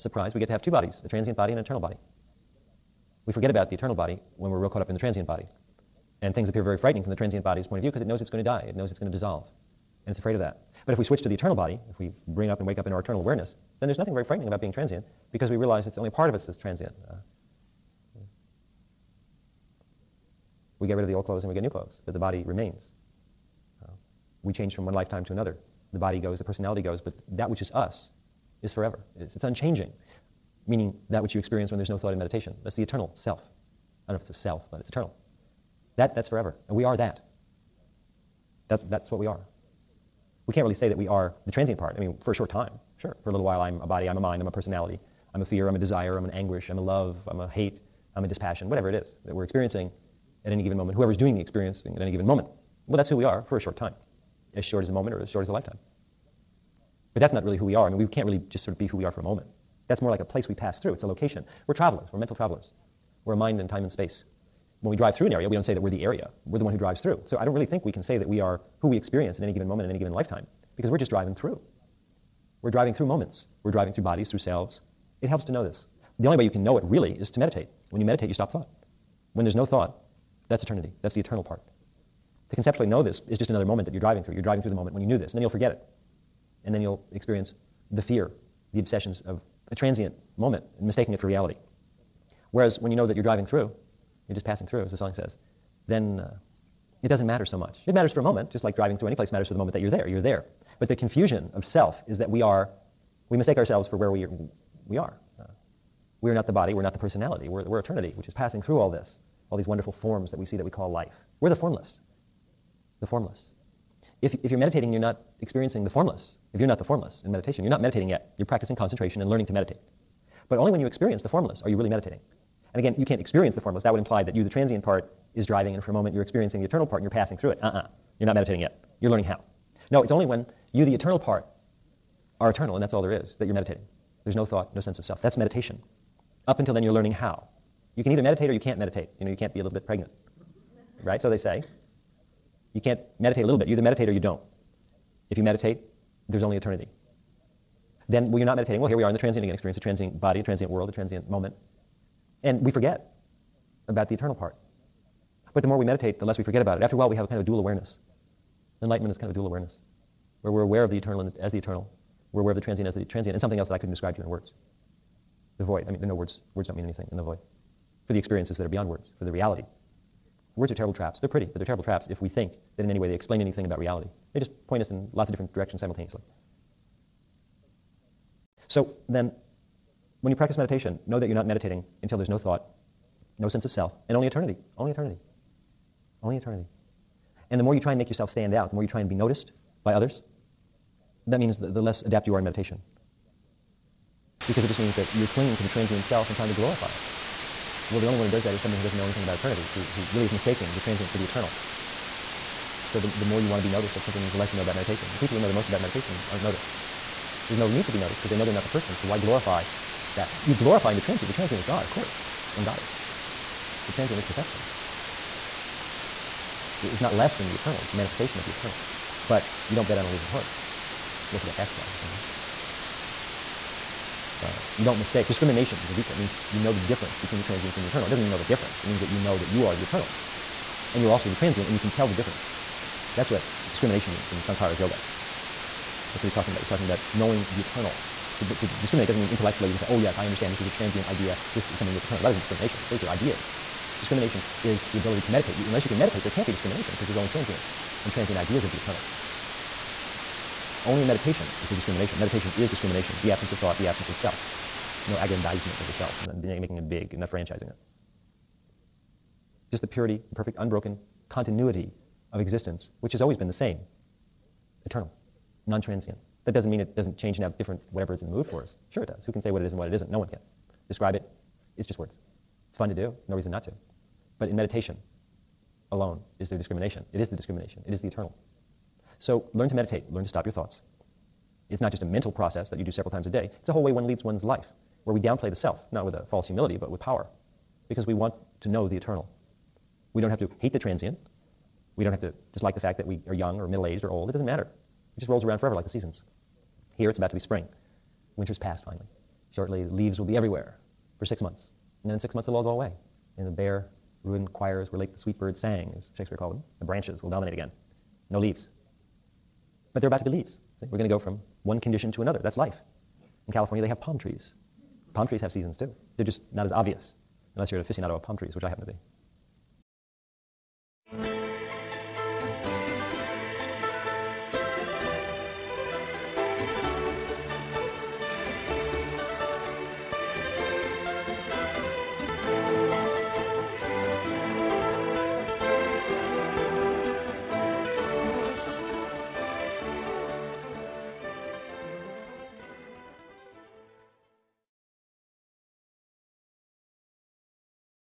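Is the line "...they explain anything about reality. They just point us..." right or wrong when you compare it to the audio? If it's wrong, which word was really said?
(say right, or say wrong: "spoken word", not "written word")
right.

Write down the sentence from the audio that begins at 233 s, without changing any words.
That's what discrimination means in Shankara's yoga.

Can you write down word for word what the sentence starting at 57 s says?
But that's not really who we are.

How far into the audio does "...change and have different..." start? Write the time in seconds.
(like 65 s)
267 s.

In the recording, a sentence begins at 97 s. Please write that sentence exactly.
It matters for a moment, just like driving through any place matters for the moment that you're there.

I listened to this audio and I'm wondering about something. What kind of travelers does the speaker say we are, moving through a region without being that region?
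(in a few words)
mental travelers.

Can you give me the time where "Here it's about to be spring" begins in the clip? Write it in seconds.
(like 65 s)
296 s.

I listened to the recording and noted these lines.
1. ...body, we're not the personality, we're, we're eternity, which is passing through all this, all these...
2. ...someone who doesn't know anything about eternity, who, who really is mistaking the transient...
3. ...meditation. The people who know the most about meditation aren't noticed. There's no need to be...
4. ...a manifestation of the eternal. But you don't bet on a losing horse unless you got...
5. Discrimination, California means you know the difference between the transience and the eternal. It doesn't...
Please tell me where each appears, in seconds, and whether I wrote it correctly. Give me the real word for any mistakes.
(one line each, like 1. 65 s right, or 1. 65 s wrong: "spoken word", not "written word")
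1. 106 s right
2. 198 s right
3. 204 s right
4. 217 s right
5. 225 s wrong: "Viveka", not "California".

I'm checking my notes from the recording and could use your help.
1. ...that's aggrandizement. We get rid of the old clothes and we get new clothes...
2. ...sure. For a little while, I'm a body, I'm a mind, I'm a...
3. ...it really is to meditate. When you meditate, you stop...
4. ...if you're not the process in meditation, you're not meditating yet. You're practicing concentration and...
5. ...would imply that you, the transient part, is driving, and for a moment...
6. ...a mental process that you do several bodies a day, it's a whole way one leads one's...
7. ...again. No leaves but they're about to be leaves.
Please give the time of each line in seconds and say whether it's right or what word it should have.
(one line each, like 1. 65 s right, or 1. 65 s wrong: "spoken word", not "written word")
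1. 16 s wrong: "transient", not "aggrandizement"
2. 42 s right
3. 76 s right
4. 116 s wrong: "formless", not "process"
5. 123 s right
6. 282 s wrong: "times", not "bodies"
7. 307 s right.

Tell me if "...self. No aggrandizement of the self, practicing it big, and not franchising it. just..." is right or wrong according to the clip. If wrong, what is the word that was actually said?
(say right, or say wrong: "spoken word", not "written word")
wrong: "making", not "practicing".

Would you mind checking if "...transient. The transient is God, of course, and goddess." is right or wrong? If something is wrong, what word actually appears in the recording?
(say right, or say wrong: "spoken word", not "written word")
right.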